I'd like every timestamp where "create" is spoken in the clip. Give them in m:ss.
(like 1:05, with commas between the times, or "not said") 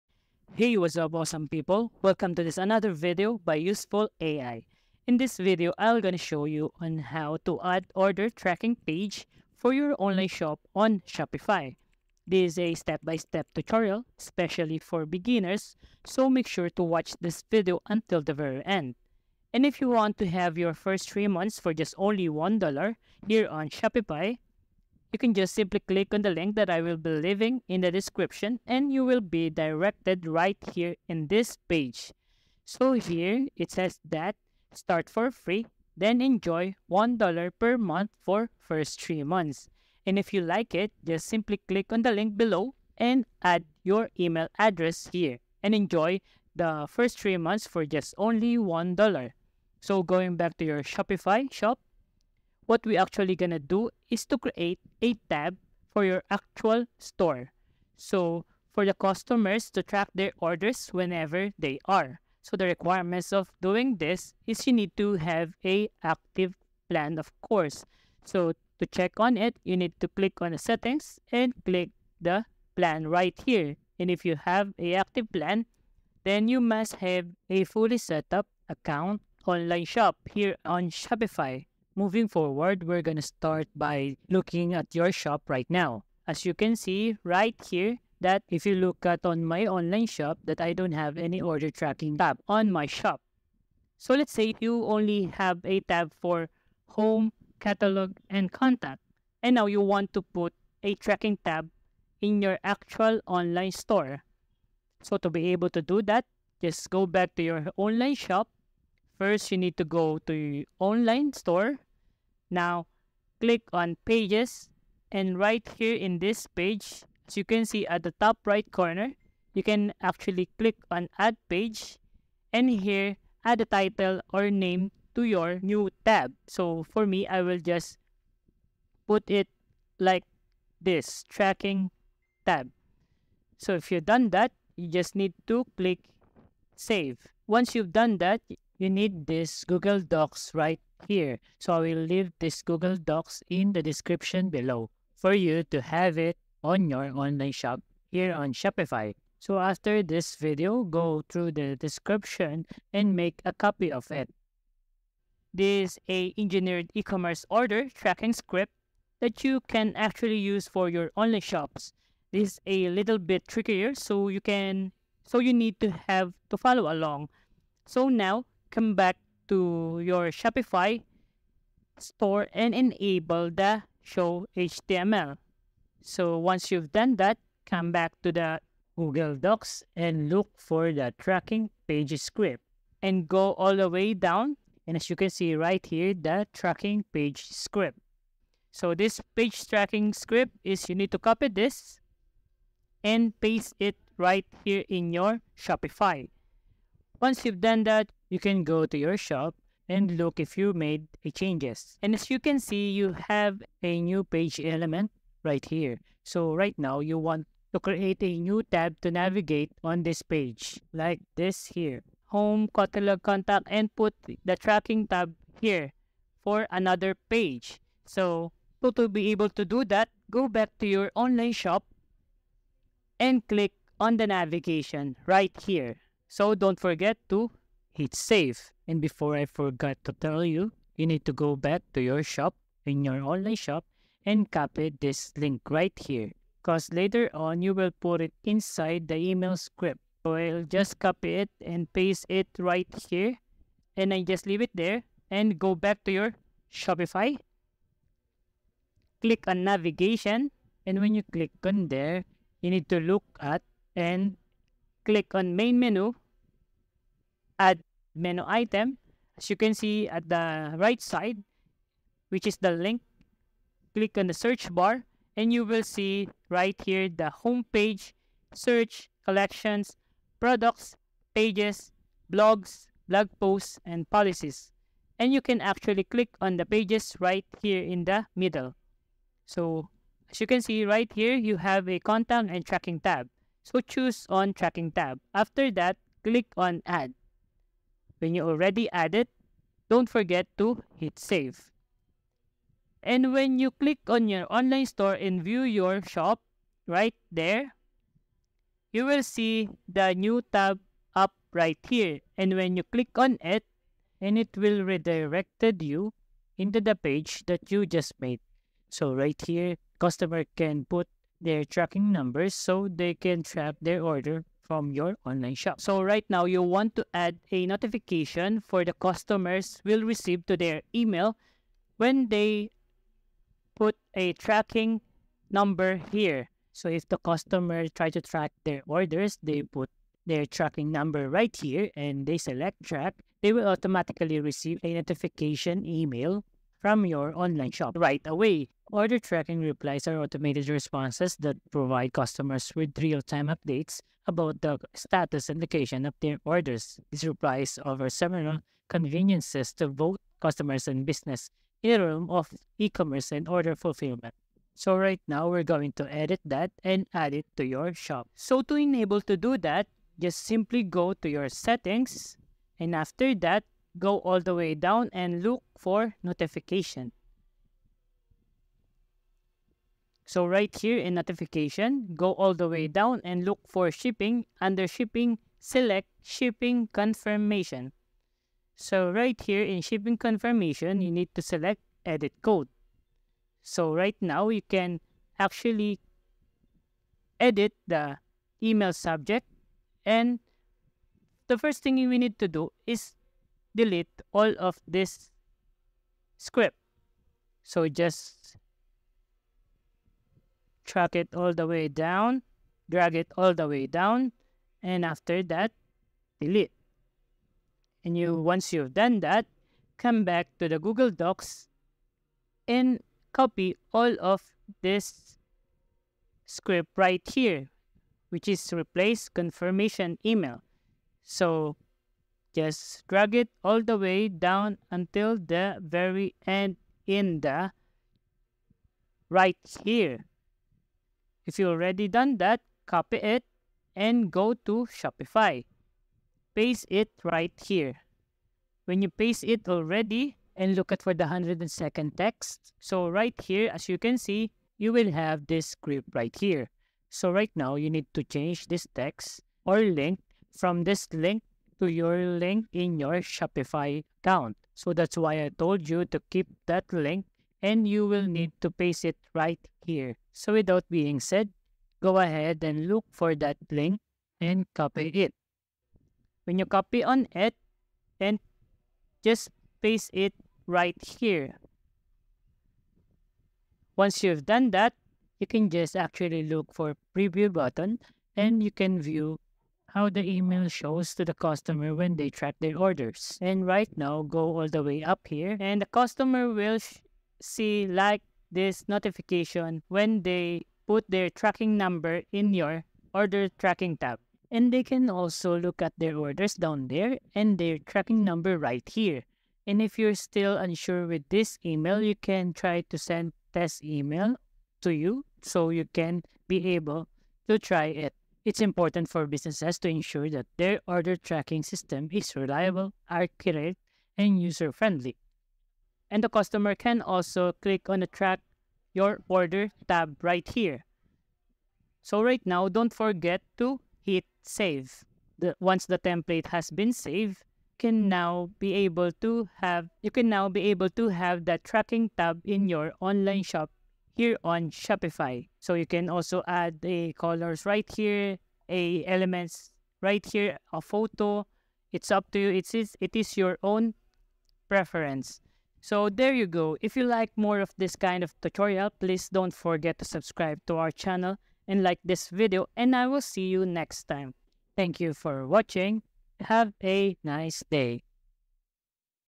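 0:54, 3:27.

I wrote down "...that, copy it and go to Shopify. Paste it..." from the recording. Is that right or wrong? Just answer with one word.
right.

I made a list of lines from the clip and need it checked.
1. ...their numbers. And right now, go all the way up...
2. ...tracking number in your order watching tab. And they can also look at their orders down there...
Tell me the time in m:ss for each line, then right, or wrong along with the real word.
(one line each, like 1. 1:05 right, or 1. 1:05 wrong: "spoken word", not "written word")
1. 8:02 wrong: "orders", not "numbers"
2. 8:11 wrong: "tracking", not "watching".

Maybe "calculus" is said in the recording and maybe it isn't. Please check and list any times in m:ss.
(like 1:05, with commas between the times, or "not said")
not said.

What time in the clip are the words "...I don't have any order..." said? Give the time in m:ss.
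1:30.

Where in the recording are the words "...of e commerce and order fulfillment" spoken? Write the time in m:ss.
5:52.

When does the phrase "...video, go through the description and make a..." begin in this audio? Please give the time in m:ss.
2:30.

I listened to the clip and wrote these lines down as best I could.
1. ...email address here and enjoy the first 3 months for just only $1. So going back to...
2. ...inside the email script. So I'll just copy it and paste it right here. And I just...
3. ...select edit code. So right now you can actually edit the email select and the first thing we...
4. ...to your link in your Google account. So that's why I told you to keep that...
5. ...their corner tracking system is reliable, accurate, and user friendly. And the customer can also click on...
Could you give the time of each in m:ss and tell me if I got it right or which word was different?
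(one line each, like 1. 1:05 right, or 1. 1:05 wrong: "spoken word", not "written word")
1. 0:44 right
2. 3:58 right
3. 6:21 wrong: "subject", not "select"
4. 7:31 wrong: "Shopify", not "Google"
5. 8:30 wrong: "order", not "corner".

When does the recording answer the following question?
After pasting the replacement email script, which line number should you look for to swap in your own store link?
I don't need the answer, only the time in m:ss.
7:21.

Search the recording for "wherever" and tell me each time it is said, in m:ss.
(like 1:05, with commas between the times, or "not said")
not said.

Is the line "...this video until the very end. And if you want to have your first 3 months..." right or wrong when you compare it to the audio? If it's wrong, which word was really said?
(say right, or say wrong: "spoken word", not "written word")
right.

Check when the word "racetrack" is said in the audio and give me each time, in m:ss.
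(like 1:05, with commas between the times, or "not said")
not said.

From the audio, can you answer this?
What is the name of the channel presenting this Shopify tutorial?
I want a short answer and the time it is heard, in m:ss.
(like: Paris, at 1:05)
Useful AI, at 0:03.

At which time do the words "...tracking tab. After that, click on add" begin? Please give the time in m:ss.
4:44.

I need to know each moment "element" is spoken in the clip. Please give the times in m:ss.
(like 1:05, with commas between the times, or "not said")
3:24, 8:59.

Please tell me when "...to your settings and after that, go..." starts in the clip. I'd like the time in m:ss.
6:01.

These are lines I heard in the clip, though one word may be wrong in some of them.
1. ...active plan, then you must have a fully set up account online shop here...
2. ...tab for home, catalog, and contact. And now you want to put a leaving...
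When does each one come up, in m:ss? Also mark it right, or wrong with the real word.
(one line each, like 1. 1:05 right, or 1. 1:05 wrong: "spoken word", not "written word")
1. 1:14 right
2. 1:35 wrong: "tracking", not "leaving".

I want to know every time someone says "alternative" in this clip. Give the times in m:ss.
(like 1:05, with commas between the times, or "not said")
not said.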